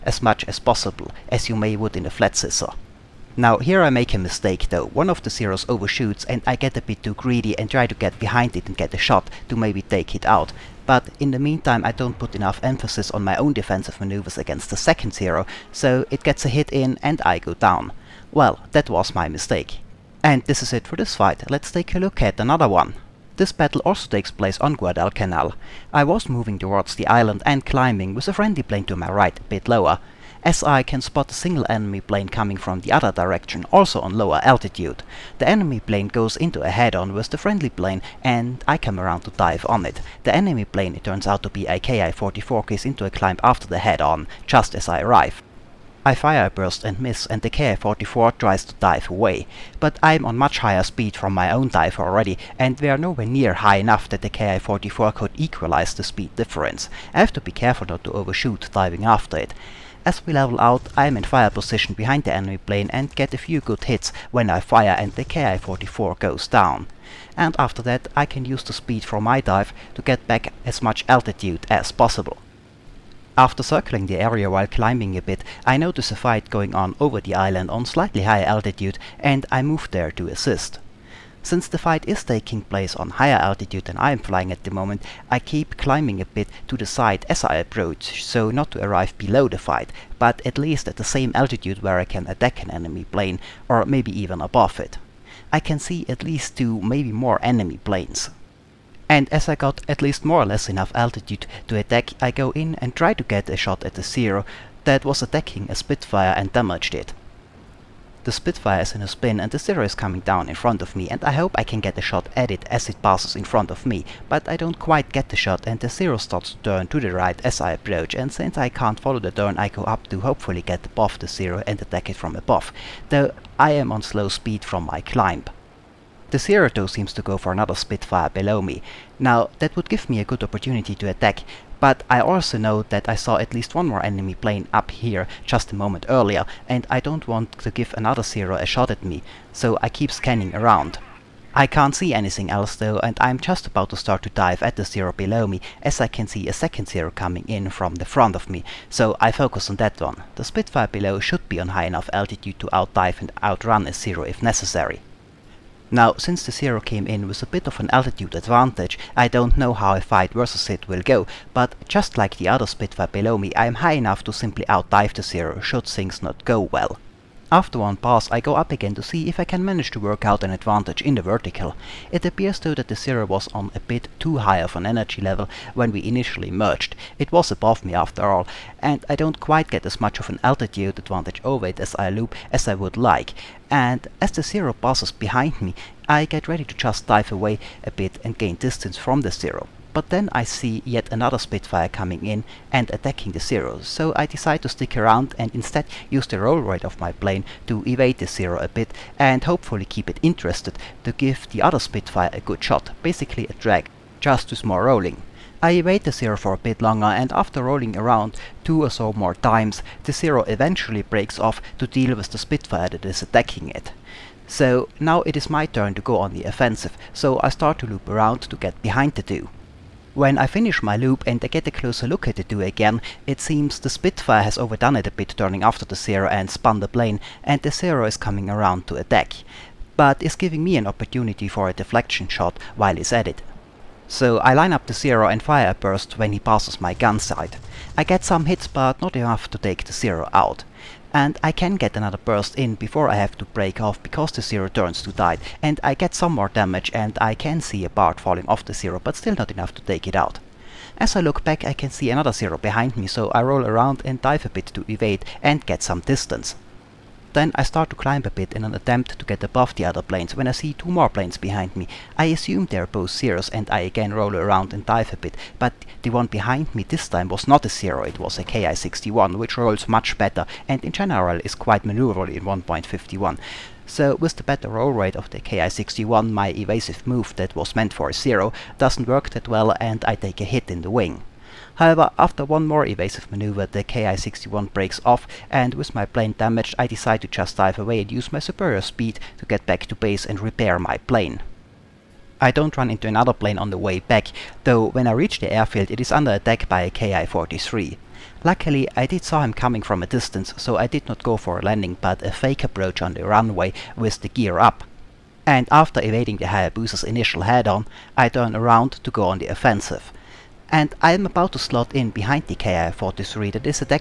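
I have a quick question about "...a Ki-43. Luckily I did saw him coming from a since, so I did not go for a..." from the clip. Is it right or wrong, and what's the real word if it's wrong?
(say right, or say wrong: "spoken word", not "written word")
wrong: "distance", not "since".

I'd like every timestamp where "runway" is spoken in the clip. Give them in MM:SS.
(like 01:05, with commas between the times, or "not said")
05:03.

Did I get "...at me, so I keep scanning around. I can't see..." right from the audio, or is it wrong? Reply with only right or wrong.
right.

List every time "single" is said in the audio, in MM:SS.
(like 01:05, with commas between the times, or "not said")
00:31.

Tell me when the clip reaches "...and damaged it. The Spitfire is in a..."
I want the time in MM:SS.
01:46.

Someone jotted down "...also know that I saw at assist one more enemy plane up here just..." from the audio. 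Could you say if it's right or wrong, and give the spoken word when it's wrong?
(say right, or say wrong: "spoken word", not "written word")
wrong: "least", not "assist".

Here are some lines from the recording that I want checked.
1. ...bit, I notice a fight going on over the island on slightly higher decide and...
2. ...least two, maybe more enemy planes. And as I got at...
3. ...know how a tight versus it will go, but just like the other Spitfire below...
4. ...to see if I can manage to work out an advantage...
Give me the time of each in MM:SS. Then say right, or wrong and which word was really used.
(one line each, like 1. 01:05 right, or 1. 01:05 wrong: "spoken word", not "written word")
1. 01:15 wrong: "altitude", not "decide"
2. 01:36 right
3. 02:39 wrong: "fight", not "tight"
4. 02:48 right.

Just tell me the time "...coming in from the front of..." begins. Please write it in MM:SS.
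02:27.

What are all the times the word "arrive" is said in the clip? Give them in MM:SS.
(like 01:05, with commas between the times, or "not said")
00:45, 01:28.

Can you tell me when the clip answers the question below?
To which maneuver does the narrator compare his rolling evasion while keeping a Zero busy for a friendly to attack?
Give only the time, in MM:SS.
03:23.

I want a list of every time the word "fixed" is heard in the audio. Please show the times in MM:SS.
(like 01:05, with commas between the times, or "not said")
not said.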